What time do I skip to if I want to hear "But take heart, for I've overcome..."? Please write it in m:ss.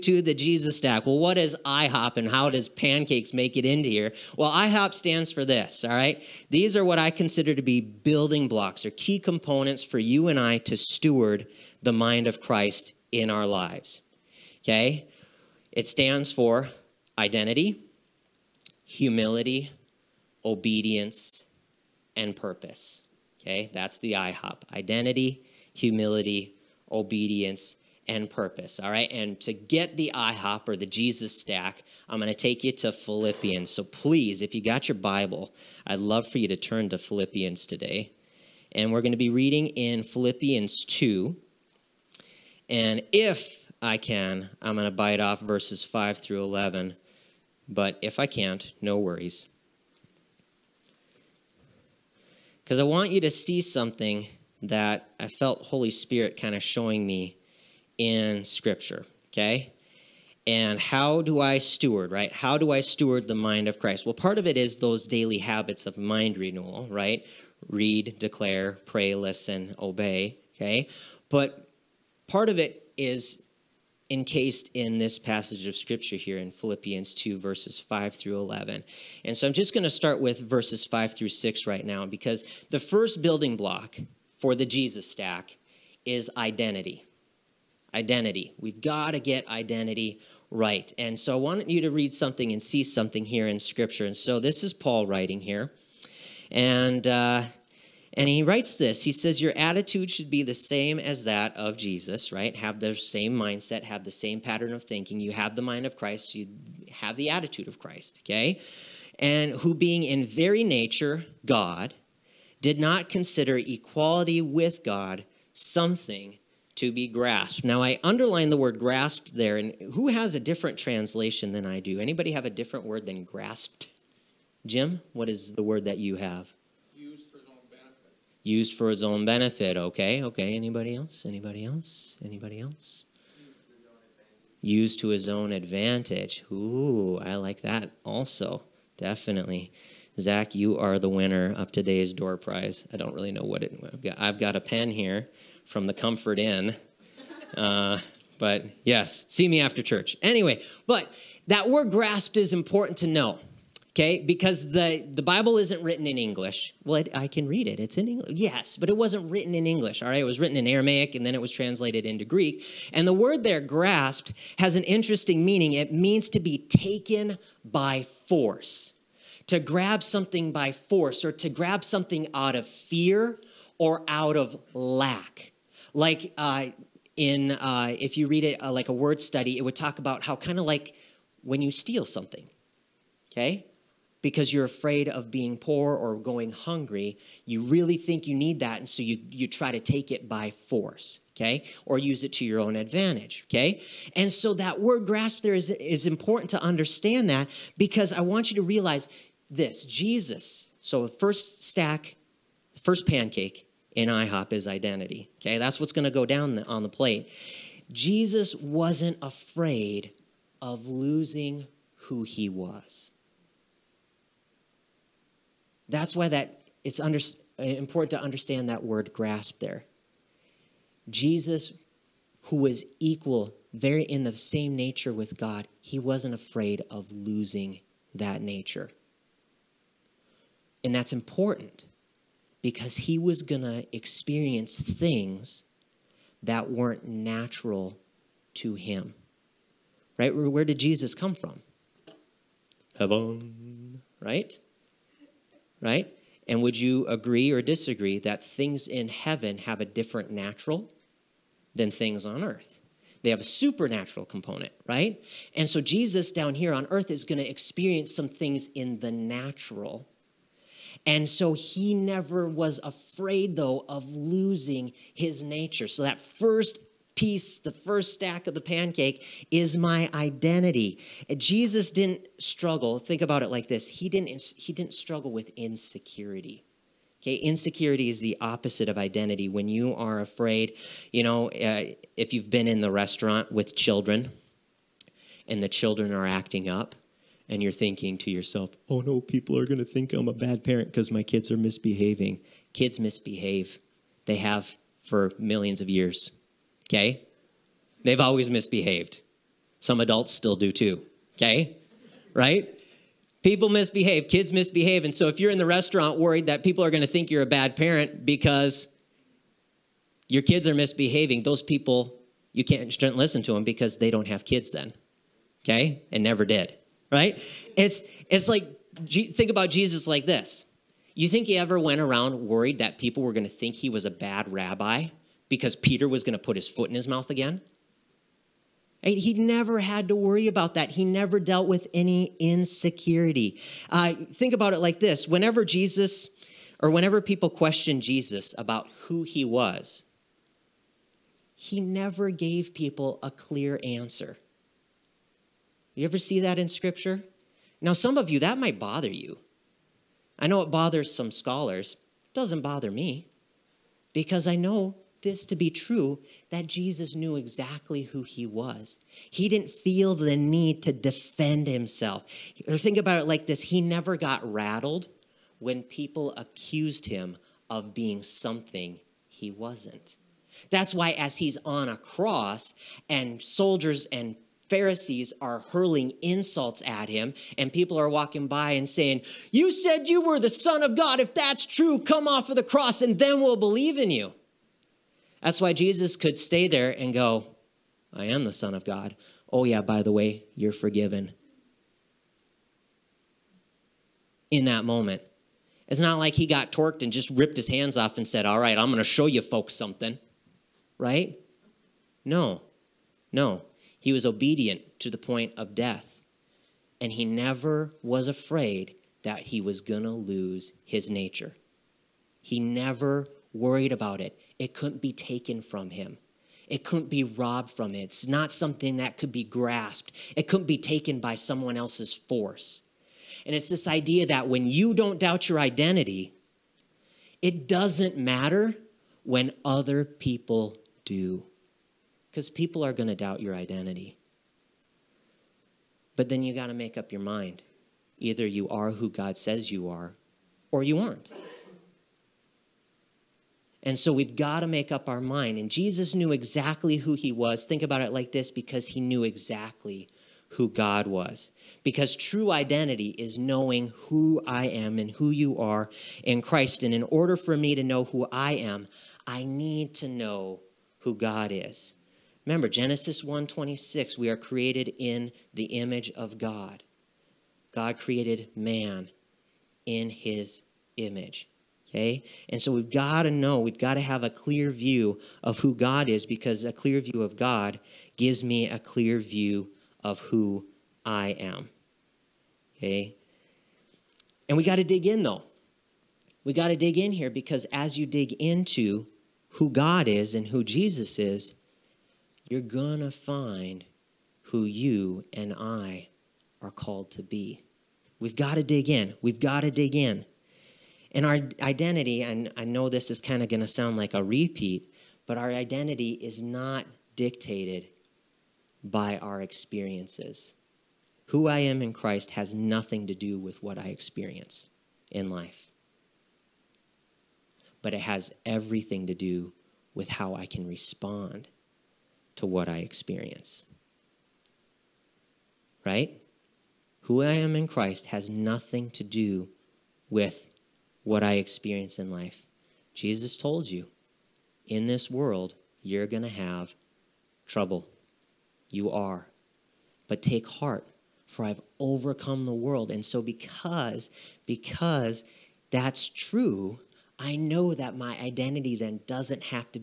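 9:00.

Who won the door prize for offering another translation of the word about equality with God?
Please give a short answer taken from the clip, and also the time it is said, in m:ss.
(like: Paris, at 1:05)
Zach, at 2:20.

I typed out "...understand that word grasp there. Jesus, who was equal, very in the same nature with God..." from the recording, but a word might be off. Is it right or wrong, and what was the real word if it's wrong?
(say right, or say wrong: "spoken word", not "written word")
right.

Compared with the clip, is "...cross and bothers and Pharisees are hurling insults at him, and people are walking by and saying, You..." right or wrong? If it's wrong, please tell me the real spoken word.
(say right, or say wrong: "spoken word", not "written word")
wrong: "soldiers", not "bothers".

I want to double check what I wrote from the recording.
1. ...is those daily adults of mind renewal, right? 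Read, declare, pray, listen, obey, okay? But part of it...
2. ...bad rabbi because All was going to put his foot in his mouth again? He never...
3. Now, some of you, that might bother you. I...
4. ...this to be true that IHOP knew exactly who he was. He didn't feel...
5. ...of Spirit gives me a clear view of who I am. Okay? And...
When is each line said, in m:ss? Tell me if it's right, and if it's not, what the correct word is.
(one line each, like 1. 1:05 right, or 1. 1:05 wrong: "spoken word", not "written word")
1. 1:04 wrong: "habits", not "adults"
2. 5:24 wrong: "Peter", not "All"
3. 5:47 right
4. 5:55 wrong: "Jesus", not "IHOP"
5. 7:57 wrong: "God", not "Spirit".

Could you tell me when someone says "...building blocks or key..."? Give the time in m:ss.
0:07.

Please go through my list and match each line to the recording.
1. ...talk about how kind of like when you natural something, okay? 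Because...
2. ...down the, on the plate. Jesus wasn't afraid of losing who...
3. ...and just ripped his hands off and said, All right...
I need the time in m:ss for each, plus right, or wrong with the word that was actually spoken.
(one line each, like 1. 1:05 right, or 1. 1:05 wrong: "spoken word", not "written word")
1. 2:59 wrong: "steal", not "natural"
2. 3:26 right
3. 6:37 right.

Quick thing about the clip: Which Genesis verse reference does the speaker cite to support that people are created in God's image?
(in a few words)
Genesis 1:26.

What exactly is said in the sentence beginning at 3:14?
And so that word grasp there is, is important to understand that because I want you to realize this Jesus.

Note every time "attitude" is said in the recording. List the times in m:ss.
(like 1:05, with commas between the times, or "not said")
1:39, 1:47.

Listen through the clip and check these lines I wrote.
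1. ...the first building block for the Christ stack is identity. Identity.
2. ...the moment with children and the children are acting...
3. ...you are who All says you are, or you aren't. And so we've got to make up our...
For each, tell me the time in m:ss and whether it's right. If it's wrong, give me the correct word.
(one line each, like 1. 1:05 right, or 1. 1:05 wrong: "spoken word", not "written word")
1. 1:22 wrong: "Jesus", not "Christ"
2. 4:42 wrong: "restaurant", not "moment"
3. 7:18 wrong: "God", not "All".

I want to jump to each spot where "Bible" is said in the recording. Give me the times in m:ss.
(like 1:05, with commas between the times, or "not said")
0:34, 2:35.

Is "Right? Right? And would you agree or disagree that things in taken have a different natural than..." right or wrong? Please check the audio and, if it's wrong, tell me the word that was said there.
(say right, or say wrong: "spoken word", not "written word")
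wrong: "heaven", not "taken".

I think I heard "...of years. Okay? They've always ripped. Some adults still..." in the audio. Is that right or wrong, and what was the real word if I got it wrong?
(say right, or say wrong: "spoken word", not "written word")
wrong: "misbehaved", not "ripped".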